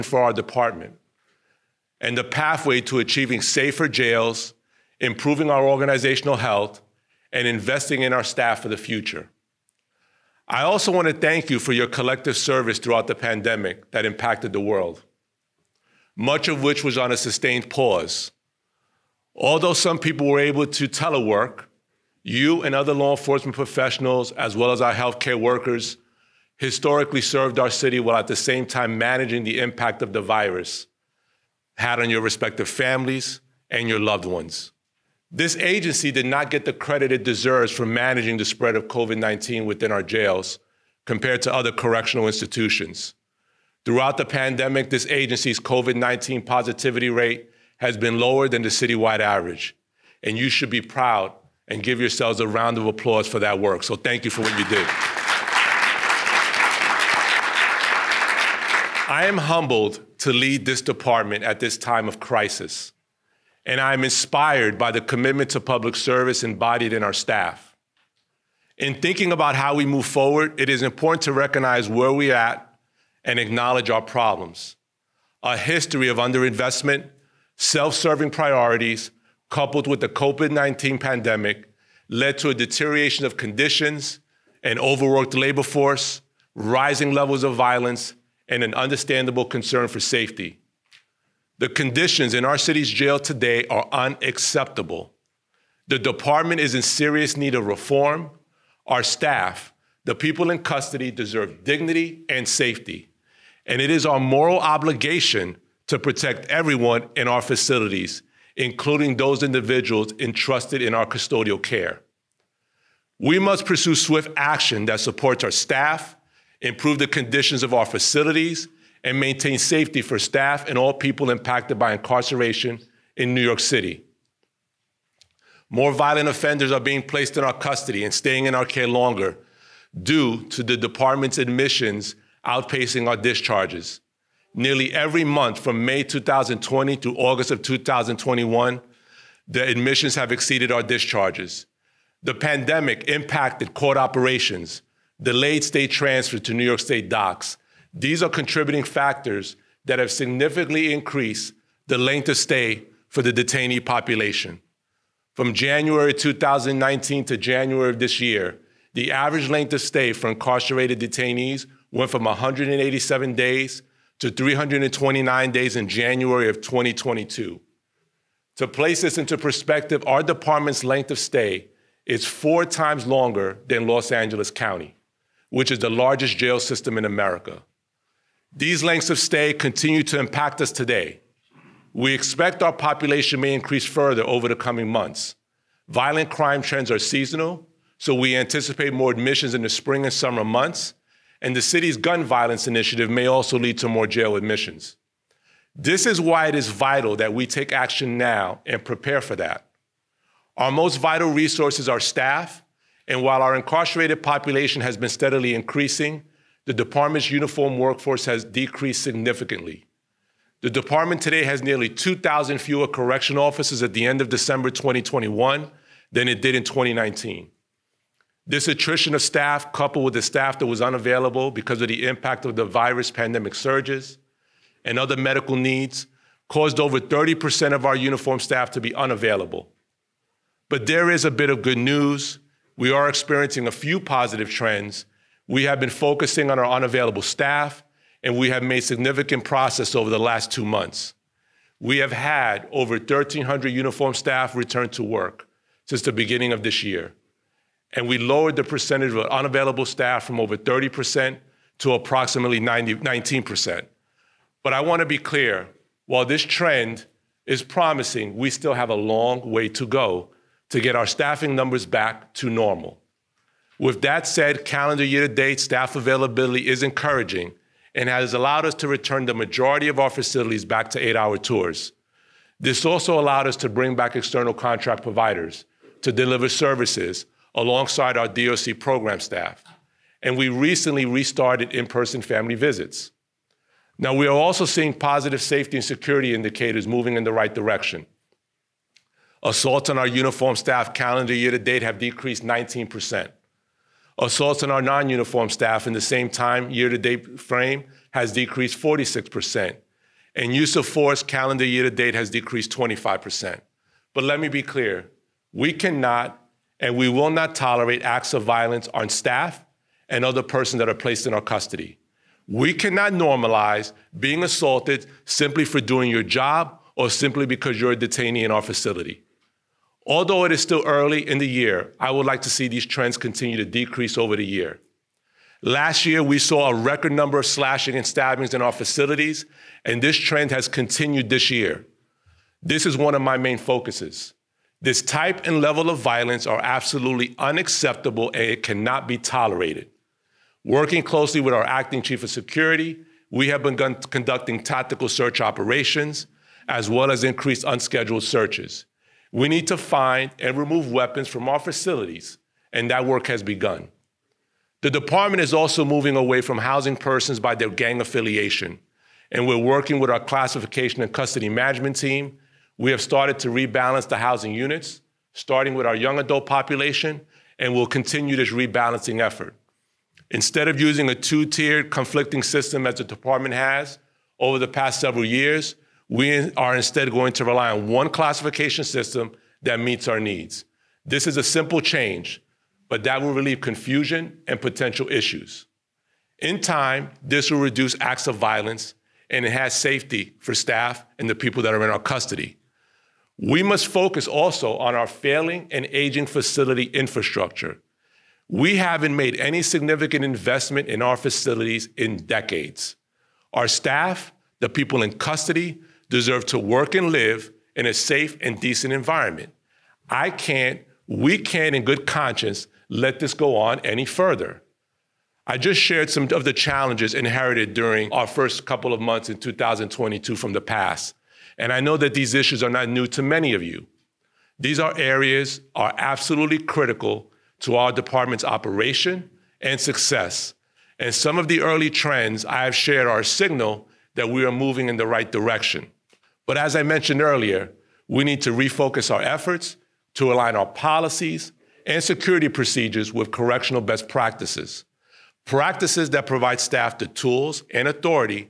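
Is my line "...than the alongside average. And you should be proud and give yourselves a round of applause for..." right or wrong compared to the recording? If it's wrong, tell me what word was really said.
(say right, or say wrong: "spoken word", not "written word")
wrong: "citywide", not "alongside".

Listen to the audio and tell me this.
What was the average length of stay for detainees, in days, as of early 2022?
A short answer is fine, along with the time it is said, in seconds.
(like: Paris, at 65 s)
329 days, at 164 s.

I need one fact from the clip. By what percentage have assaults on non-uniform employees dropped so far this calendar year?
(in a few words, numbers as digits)
46%.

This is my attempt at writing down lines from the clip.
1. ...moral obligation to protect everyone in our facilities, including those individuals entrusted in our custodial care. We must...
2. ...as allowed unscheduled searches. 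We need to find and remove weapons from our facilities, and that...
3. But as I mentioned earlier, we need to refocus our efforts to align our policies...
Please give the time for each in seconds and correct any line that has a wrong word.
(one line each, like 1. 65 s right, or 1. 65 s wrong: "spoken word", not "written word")
1. 104 s right
2. 347 s wrong: "increased", not "allowed"
3. 436 s right.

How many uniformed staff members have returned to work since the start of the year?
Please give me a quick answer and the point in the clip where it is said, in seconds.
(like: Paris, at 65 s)
1,300, at 242 s.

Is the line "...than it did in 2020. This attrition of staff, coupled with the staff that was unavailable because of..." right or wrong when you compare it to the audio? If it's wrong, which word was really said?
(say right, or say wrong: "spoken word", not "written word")
wrong: "2019", not "2020".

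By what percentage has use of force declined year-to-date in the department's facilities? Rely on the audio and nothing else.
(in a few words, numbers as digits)
25%.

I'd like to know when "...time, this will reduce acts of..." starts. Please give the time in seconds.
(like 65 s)
386 s.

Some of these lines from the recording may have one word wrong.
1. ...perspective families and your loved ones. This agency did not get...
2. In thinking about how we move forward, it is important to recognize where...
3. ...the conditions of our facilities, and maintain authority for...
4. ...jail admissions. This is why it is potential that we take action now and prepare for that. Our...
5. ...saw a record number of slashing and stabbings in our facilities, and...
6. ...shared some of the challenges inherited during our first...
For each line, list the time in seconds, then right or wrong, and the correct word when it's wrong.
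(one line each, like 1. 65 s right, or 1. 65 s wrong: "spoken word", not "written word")
1. 32 s wrong: "respective", not "perspective"
2. 68 s right
3. 116 s wrong: "safety", not "authority"
4. 194 s wrong: "vital", not "potential"
5. 326 s right
6. 415 s right.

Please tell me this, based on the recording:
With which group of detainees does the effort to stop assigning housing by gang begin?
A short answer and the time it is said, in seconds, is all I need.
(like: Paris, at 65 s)
young adult population, at 365 s.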